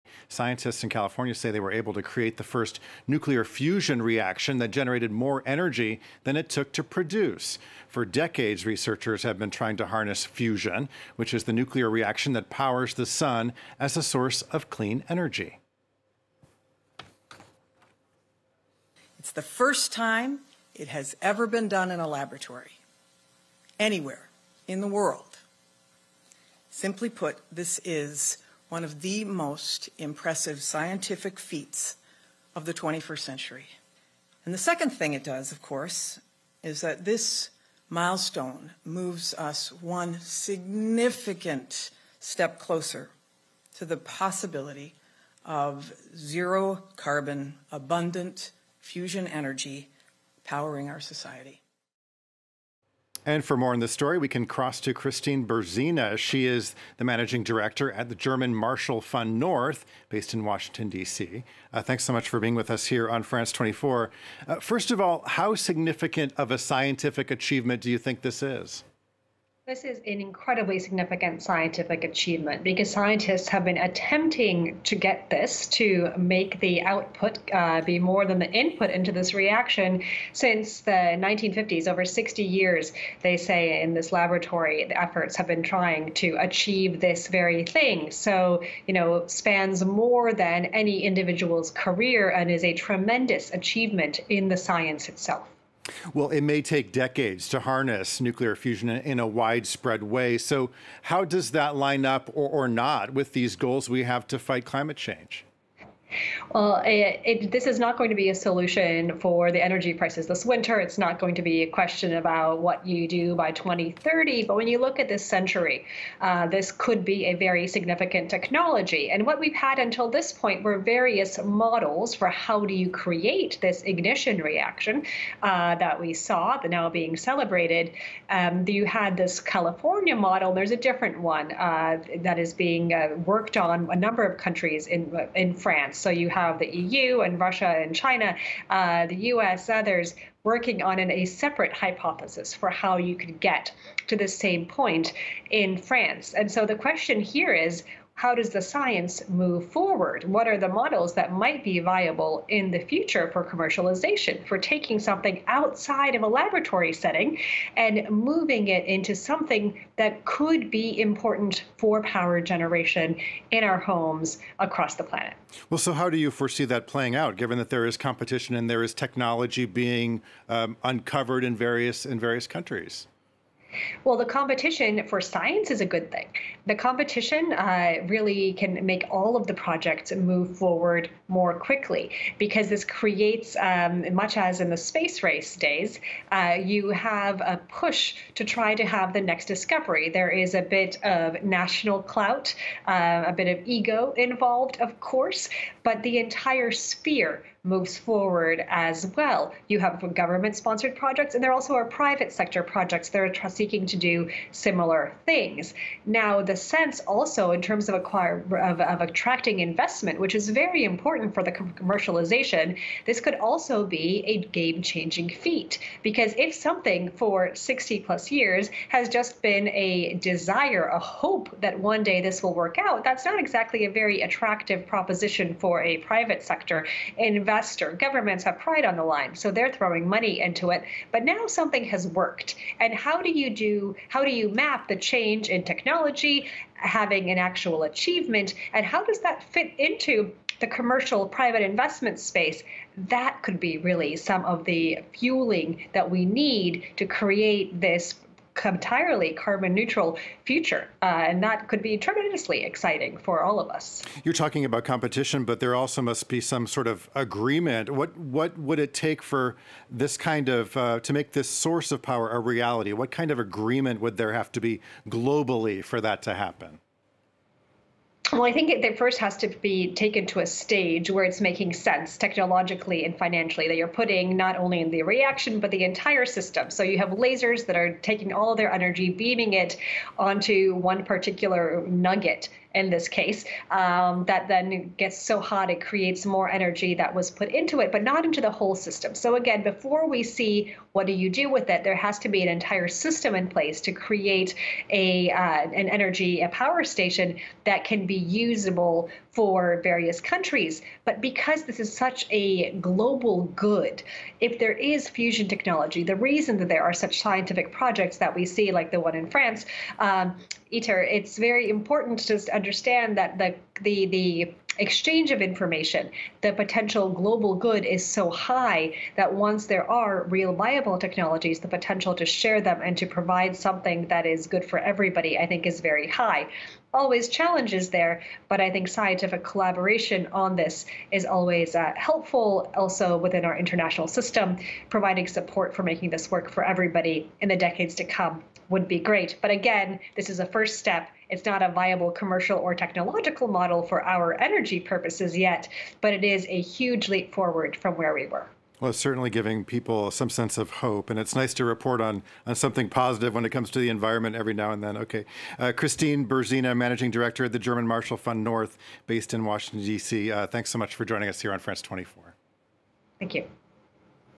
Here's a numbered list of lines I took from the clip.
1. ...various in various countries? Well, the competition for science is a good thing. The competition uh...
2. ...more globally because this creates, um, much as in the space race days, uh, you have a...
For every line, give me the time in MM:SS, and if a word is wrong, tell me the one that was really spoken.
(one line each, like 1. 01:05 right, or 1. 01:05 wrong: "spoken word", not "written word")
1. 02:51 right
2. 03:01 wrong: "quickly", not "globally".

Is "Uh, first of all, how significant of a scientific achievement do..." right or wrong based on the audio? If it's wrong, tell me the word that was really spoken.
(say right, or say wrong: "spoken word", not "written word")
right.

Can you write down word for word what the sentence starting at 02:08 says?
Um, you had this California model.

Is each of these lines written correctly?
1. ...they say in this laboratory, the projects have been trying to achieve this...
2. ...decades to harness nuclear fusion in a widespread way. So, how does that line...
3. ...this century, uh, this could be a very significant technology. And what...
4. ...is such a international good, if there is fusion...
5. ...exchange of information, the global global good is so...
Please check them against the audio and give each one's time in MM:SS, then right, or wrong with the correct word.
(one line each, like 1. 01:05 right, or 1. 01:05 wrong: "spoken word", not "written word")
1. 01:23 wrong: "efforts", not "projects"
2. 01:36 right
3. 01:55 right
4. 05:01 wrong: "global", not "international"
5. 05:14 wrong: "potential", not "global".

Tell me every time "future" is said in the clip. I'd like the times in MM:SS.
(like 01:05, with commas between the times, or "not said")
02:32, 04:10.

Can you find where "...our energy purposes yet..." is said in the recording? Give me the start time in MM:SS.
05:44.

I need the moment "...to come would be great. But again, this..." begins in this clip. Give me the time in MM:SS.
05:37.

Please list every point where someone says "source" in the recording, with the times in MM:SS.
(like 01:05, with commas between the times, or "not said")
00:14, 04:21.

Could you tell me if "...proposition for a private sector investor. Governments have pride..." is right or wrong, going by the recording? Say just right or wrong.
right.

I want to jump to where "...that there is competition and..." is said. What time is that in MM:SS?
02:47.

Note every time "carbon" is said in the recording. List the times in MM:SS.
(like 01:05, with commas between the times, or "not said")
00:46, 04:09.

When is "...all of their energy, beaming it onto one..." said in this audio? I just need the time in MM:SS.
04:38.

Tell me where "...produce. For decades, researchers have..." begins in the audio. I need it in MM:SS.
00:06.